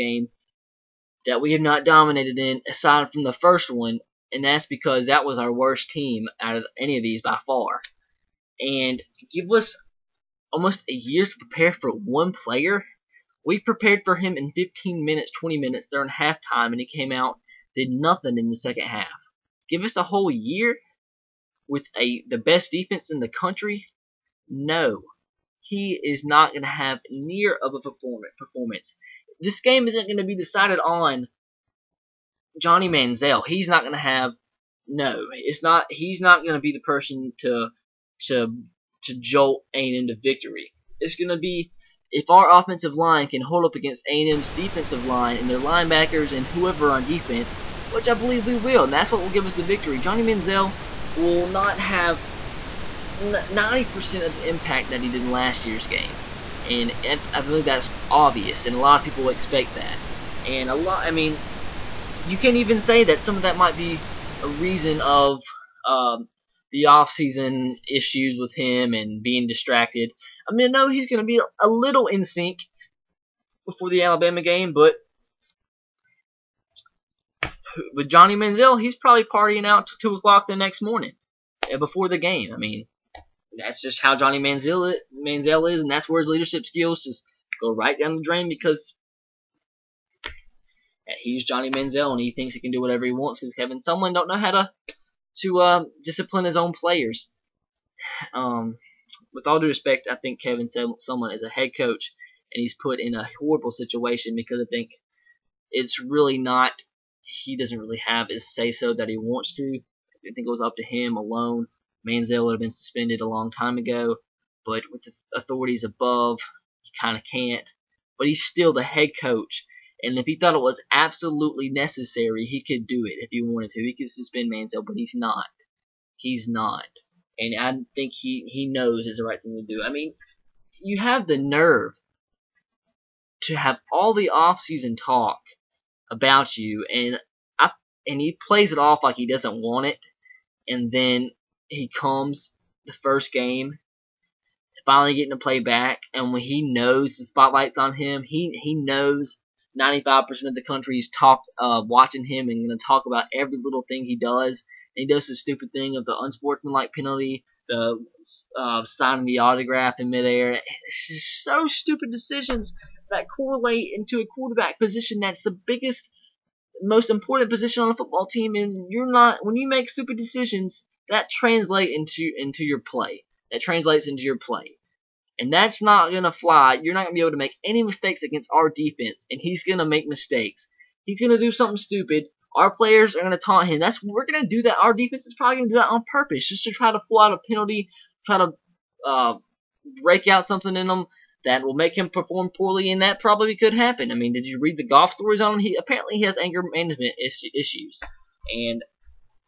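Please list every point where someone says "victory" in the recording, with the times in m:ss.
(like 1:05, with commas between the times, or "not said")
0:40, 0:49.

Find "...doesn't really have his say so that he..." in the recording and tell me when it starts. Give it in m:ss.
1:47.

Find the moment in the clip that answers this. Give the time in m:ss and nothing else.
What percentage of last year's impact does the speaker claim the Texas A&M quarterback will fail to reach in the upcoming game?
0:53.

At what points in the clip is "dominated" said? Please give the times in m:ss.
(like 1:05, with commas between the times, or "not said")
0:01.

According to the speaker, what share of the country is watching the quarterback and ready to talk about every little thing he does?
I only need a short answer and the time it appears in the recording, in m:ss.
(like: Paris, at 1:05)
95%, at 2:29.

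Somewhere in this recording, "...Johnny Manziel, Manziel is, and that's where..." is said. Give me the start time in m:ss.
1:24.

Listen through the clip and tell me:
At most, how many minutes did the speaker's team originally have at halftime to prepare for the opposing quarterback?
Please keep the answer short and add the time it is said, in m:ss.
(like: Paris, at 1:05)
20 minutes, at 0:15.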